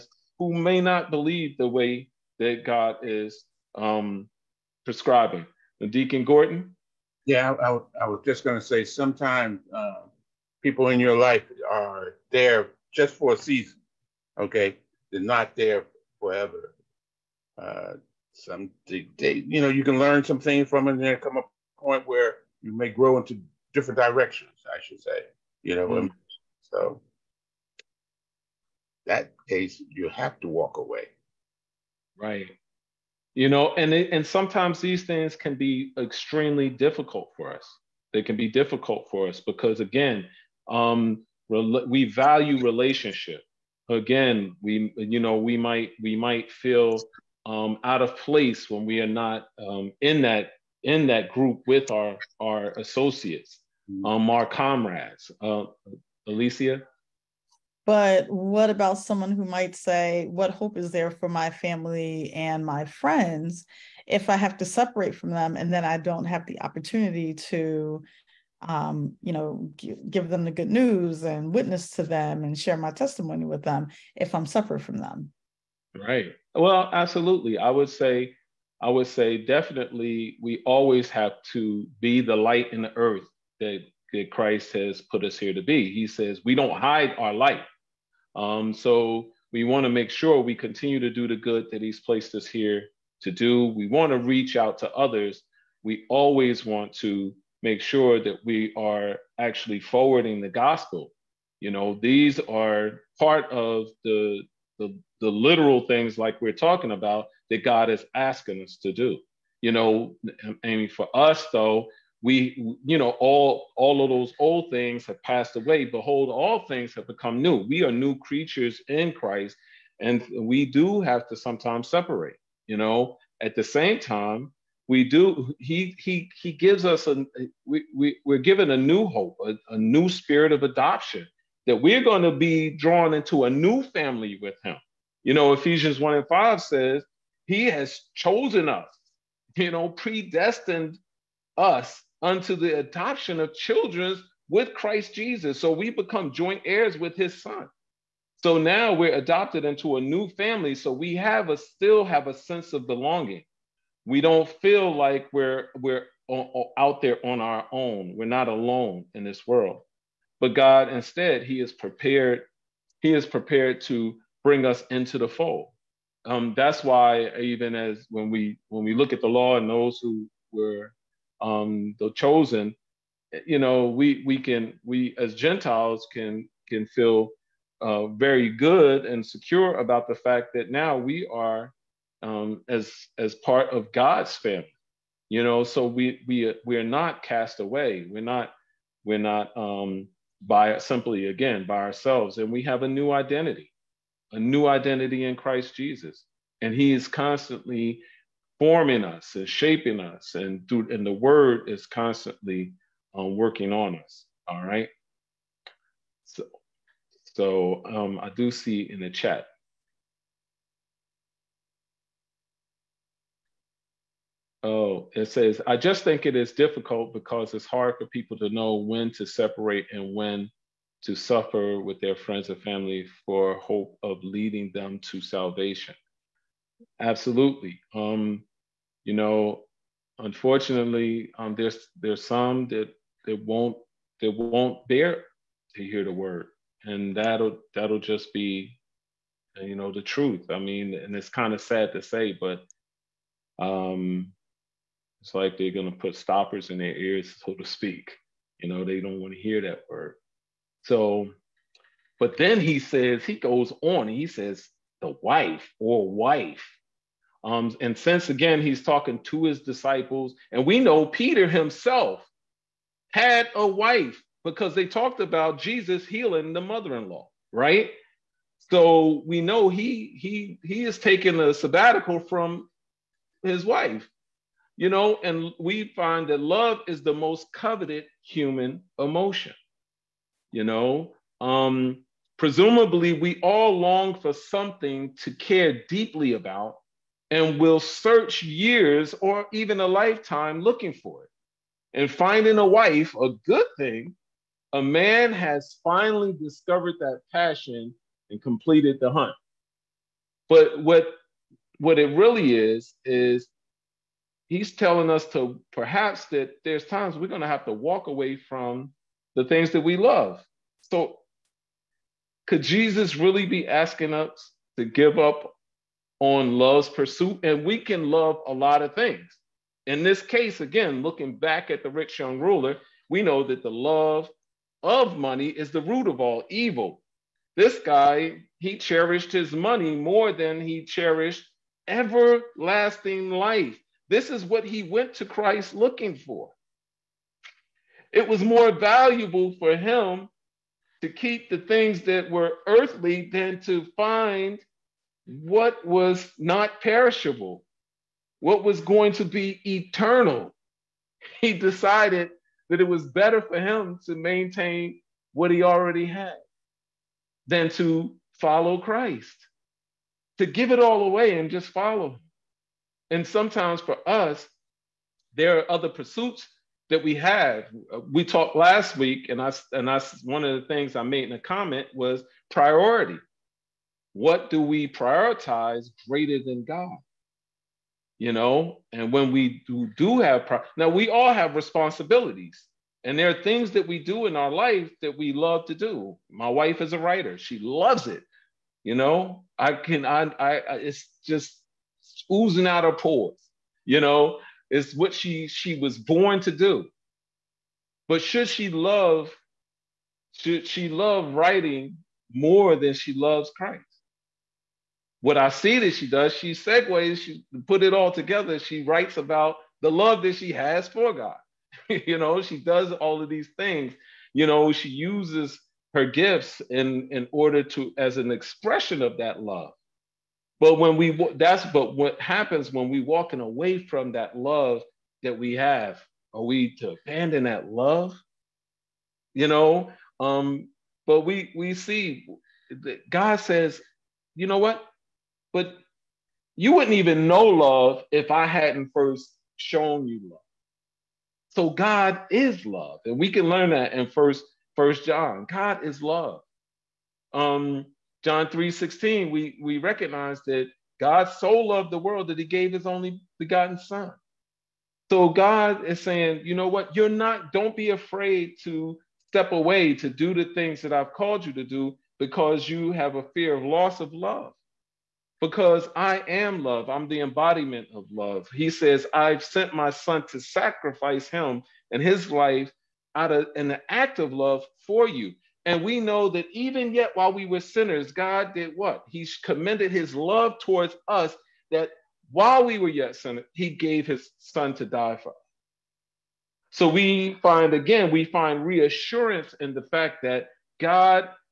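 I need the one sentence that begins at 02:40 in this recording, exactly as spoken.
But God instead, he is prepared, he is prepared to bring us into the fold.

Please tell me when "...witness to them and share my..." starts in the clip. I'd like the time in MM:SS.
01:11.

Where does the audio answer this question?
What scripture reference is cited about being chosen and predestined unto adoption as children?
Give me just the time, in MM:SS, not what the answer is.
02:15.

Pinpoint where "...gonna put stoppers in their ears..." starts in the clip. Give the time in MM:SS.
04:05.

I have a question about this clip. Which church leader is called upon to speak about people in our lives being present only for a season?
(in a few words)
Deacon Gordon.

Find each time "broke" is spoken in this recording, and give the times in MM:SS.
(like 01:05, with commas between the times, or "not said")
not said.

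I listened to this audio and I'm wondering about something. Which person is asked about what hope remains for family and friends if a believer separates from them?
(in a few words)
Alicia.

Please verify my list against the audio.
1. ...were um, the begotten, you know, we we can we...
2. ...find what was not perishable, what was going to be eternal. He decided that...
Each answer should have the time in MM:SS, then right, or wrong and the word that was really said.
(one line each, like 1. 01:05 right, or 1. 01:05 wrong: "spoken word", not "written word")
1. 02:50 wrong: "chosen", not "begotten"
2. 05:43 right.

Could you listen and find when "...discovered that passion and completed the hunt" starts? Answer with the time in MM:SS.
04:56.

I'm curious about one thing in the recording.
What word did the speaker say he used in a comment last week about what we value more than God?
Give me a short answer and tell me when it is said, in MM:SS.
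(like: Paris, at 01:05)
Priority, at 06:12.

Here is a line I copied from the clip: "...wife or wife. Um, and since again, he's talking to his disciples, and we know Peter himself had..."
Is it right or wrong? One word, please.
right.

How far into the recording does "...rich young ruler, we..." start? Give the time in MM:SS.
05:21.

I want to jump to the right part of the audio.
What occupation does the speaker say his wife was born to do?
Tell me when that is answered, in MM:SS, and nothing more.
06:26.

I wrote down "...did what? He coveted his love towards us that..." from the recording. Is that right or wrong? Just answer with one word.
wrong.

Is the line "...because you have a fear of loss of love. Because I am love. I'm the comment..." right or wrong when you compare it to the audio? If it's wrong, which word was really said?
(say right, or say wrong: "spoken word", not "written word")
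wrong: "embodiment", not "comment".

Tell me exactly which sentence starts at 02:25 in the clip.
So we become joint heirs with his son.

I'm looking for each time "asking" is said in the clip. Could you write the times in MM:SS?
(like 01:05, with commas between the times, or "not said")
01:48, 05:13.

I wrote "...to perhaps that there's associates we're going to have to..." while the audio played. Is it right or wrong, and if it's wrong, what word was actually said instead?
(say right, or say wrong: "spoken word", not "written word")
wrong: "times", not "associates".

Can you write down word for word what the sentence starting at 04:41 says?
Um, Presumably, we all long for something to care deeply about and will search years or even a lifetime looking for it.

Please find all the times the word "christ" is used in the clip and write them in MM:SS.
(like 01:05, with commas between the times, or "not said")
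01:24, 01:59, 02:24, 03:15, 05:35, 05:58, 06:43.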